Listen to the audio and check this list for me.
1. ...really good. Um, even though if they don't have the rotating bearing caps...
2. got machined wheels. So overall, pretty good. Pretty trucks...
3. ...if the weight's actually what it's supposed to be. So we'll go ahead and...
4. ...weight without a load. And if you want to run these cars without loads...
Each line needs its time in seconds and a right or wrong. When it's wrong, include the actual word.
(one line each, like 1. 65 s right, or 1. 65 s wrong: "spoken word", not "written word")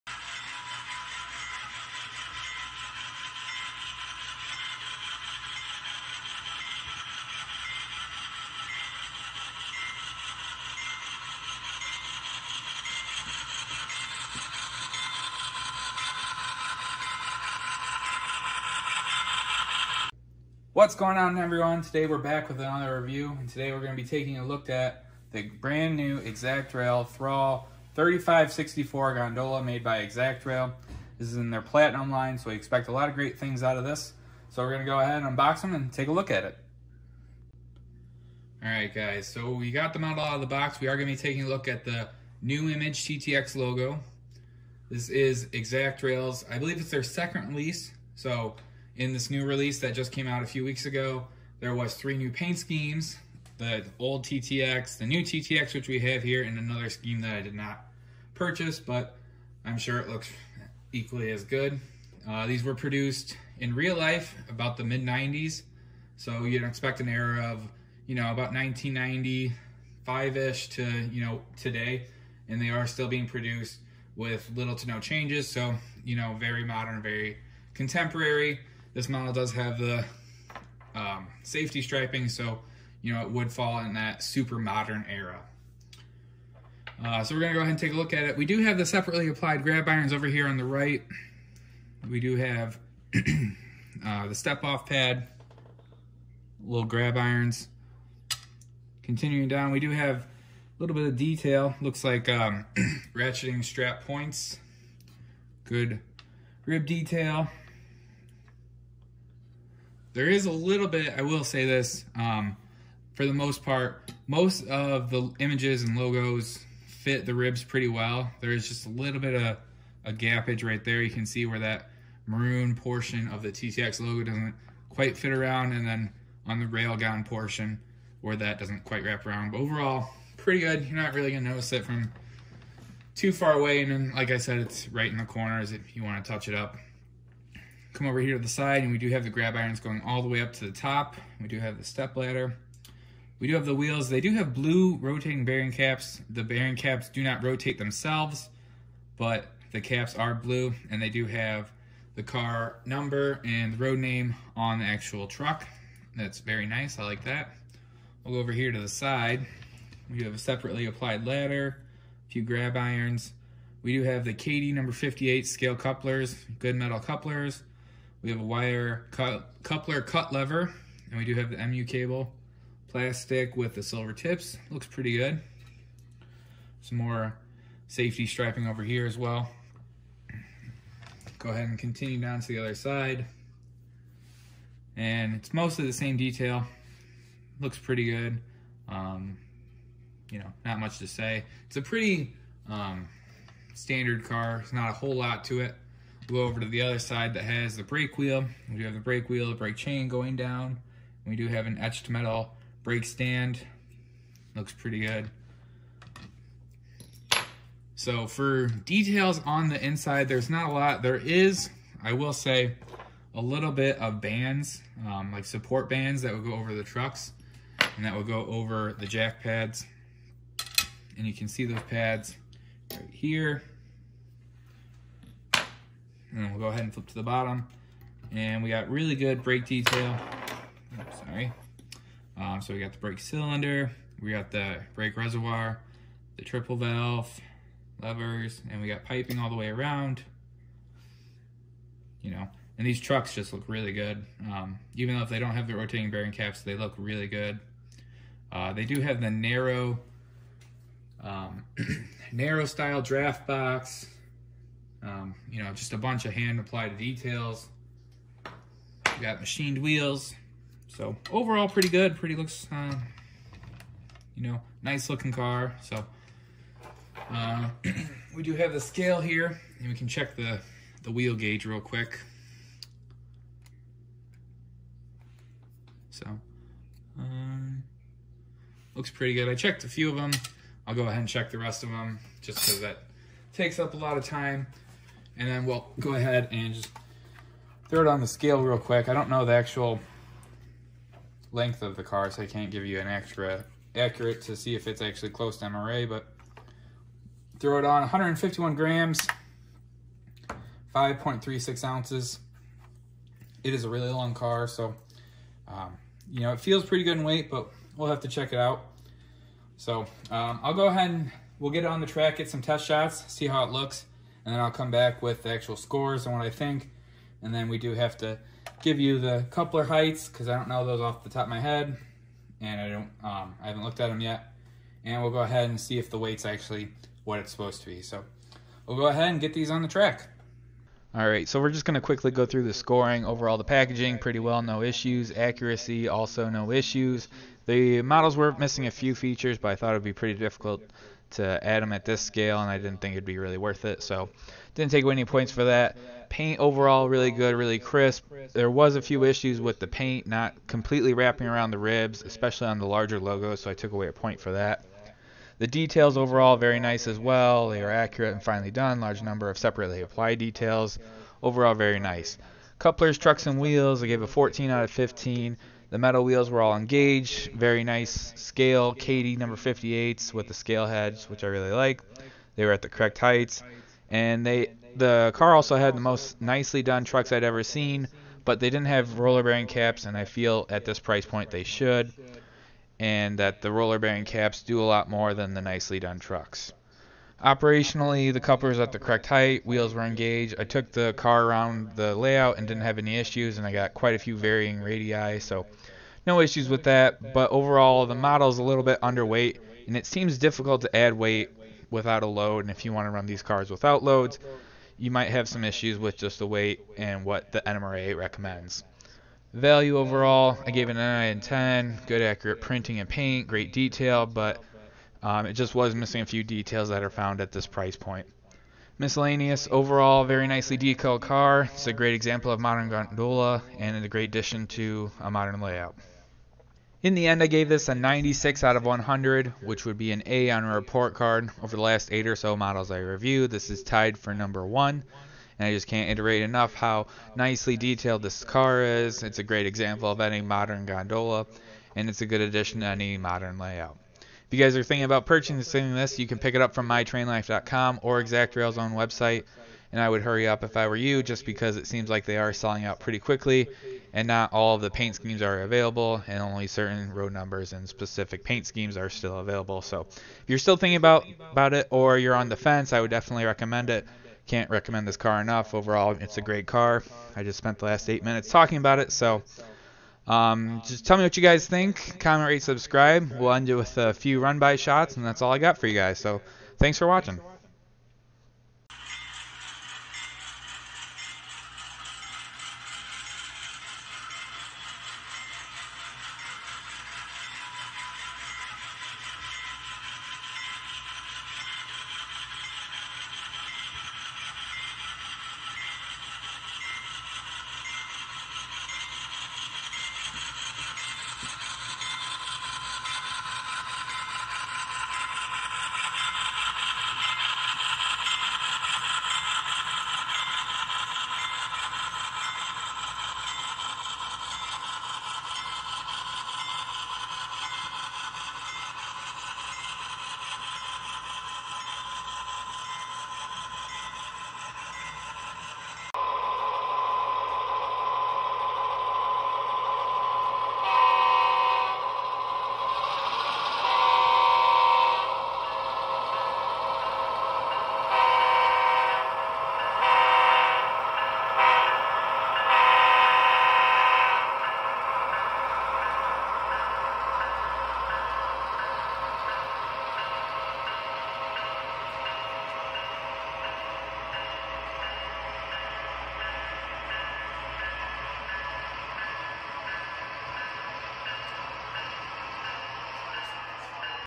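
1. 243 s right
2. 259 s wrong: "looks", not "trucks"
3. 325 s right
4. 401 s right.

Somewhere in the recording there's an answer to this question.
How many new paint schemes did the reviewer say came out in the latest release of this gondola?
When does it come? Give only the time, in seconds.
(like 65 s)
51 s.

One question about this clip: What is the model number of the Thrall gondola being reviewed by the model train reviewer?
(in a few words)
3564.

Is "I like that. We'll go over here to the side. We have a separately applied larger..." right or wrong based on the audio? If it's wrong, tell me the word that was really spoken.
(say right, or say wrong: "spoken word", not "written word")
wrong: "ladder", not "larger".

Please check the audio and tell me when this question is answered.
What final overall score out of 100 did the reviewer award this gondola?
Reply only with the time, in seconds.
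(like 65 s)
427 s.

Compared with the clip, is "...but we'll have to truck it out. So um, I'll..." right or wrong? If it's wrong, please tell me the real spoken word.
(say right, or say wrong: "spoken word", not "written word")
wrong: "check", not "truck".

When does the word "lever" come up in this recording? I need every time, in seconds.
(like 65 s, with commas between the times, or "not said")
170 s, 238 s.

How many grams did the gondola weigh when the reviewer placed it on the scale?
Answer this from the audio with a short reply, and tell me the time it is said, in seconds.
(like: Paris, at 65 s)
151 grams, at 298 s.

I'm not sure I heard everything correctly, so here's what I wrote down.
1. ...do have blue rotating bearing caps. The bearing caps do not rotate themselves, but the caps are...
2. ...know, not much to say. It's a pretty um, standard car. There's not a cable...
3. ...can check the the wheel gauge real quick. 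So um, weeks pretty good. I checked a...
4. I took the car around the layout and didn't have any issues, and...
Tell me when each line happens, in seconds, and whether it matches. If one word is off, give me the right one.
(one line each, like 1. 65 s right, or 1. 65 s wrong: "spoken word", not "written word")
1. 144 s right
2. 190 s wrong: "whole", not "cable"
3. 269 s wrong: "looks", not "weeks"
4. 390 s right.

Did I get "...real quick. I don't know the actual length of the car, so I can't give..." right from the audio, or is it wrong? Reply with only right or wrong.
right.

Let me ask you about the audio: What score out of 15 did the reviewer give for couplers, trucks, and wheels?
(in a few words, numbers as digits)
14.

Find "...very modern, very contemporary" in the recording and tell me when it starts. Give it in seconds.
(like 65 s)
76 s.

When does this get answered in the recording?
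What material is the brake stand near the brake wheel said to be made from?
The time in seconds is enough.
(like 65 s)
201 s.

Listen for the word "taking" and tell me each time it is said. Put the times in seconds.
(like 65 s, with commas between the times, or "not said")
24 s, 41 s.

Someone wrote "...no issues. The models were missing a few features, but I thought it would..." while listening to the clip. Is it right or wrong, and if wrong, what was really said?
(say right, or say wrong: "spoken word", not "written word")
right.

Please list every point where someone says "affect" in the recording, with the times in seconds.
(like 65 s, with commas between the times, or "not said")
not said.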